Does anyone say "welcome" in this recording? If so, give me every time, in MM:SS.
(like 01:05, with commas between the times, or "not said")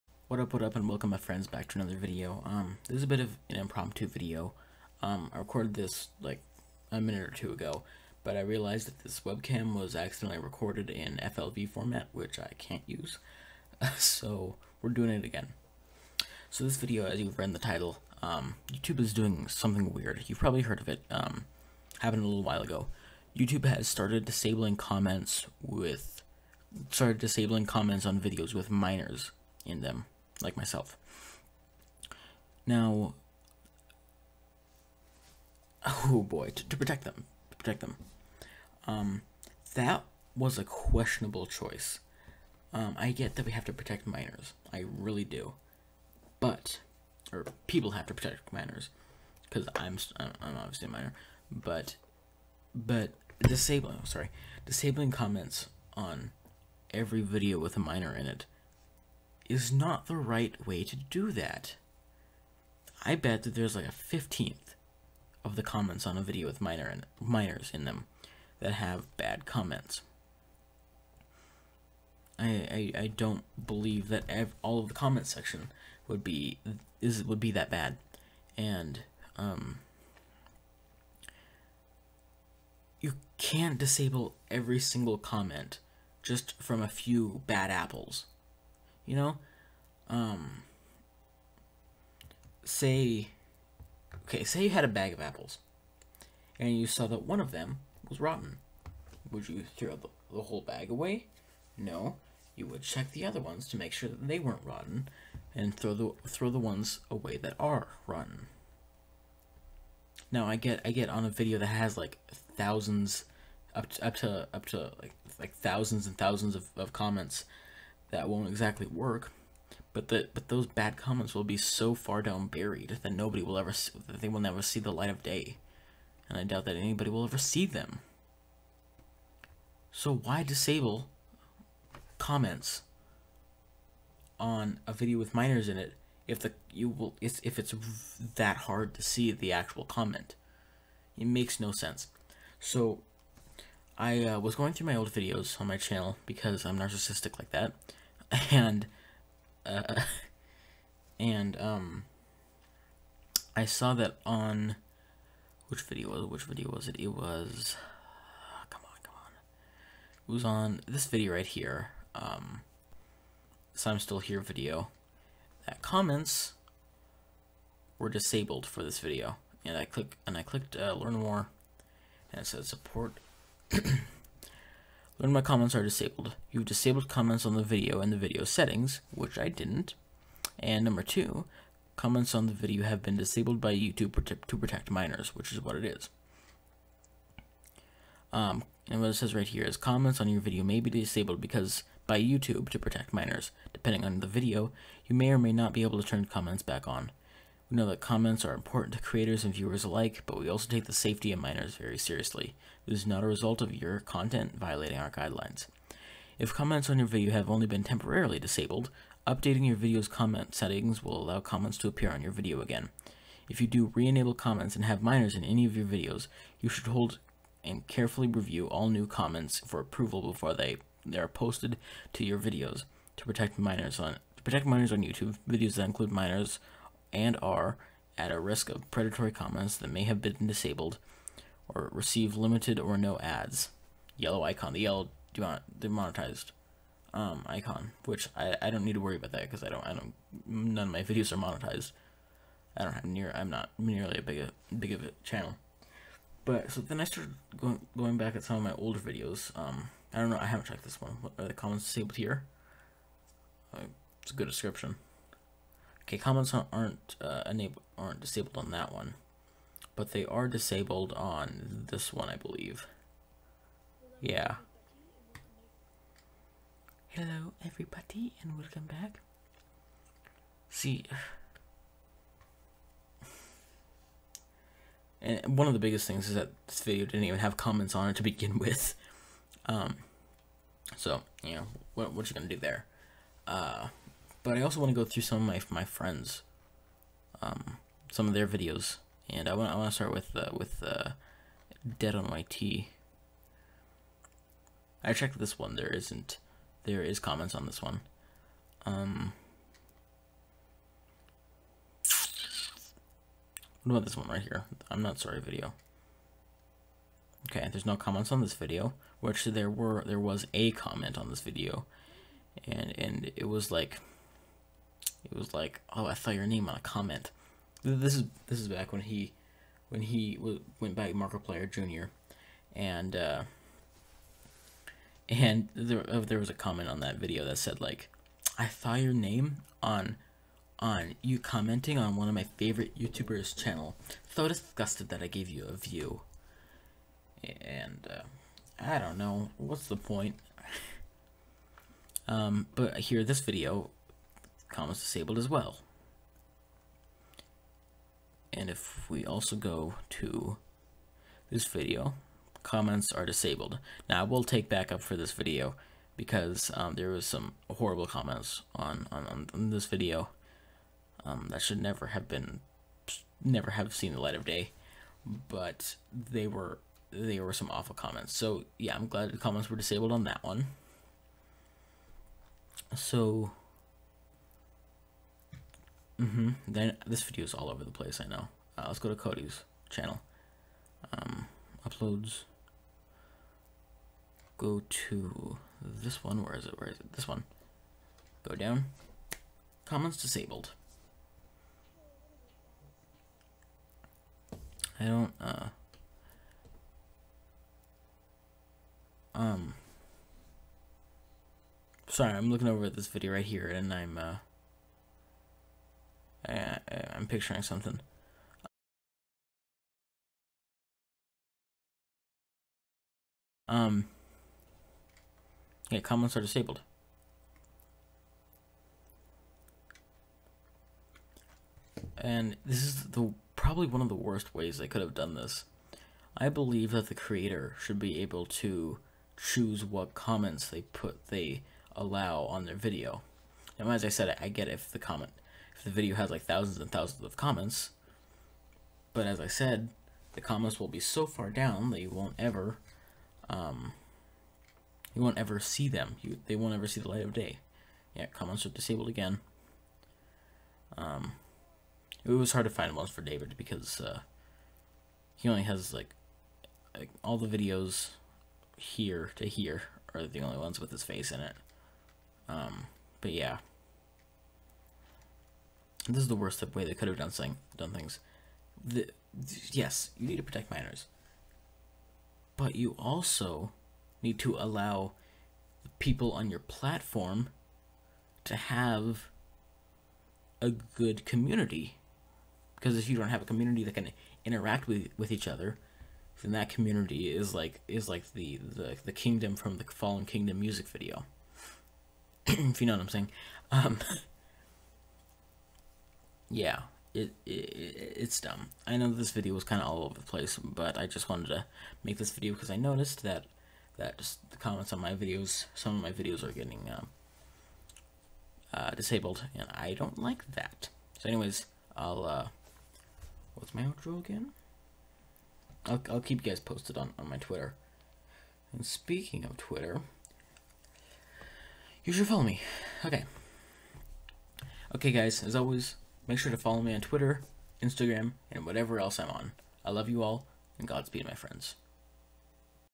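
00:00, 04:28.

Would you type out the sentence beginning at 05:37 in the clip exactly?
And uh, I don't know what's the point.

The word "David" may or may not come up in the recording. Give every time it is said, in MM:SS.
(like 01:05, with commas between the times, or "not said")
07:33.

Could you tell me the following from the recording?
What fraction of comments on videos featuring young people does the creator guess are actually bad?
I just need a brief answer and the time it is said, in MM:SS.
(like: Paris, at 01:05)
a 15th, at 01:03.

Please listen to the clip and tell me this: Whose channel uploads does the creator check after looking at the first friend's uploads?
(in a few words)
Cody.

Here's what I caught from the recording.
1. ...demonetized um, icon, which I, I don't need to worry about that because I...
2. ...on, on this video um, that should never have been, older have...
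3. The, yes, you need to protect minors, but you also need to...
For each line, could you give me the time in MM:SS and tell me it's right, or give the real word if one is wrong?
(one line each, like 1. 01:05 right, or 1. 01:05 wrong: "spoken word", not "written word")
1. 03:55 right
2. 05:59 wrong: "never", not "older"
3. 07:48 right.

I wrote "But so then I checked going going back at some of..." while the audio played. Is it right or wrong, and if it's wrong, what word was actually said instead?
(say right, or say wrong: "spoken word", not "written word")
wrong: "started", not "checked".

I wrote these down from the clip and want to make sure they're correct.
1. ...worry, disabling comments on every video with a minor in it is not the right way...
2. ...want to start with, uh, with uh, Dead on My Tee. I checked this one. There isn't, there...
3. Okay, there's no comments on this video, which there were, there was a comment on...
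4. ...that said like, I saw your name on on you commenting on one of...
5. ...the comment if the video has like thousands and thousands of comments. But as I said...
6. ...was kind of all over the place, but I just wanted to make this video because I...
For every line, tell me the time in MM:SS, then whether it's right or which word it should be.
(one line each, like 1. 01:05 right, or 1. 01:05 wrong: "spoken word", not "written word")
1. 00:54 wrong: "sorry", not "worry"
2. 04:49 right
3. 05:07 right
4. 05:27 right
5. 07:14 right
6. 08:19 right.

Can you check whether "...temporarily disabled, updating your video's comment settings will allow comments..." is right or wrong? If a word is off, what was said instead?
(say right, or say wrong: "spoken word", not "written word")
right.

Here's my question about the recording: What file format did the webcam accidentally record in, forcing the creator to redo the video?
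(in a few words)
FLV.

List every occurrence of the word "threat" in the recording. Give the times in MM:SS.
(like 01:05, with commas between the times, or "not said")
not said.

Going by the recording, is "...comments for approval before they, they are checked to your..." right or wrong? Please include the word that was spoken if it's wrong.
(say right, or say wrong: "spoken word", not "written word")
wrong: "posted", not "checked".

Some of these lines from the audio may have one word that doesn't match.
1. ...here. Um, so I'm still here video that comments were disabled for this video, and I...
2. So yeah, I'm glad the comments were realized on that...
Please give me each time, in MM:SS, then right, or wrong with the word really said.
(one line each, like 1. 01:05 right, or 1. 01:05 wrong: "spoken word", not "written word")
1. 02:41 right
2. 06:08 wrong: "disabled", not "realized".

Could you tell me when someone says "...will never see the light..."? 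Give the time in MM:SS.
02:04.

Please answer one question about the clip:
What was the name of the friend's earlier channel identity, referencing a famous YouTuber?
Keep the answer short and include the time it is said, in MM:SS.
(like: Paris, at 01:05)
Markiplier Jr., at 05:21.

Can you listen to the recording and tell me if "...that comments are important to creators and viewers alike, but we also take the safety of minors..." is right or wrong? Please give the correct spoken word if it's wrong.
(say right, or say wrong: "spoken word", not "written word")
right.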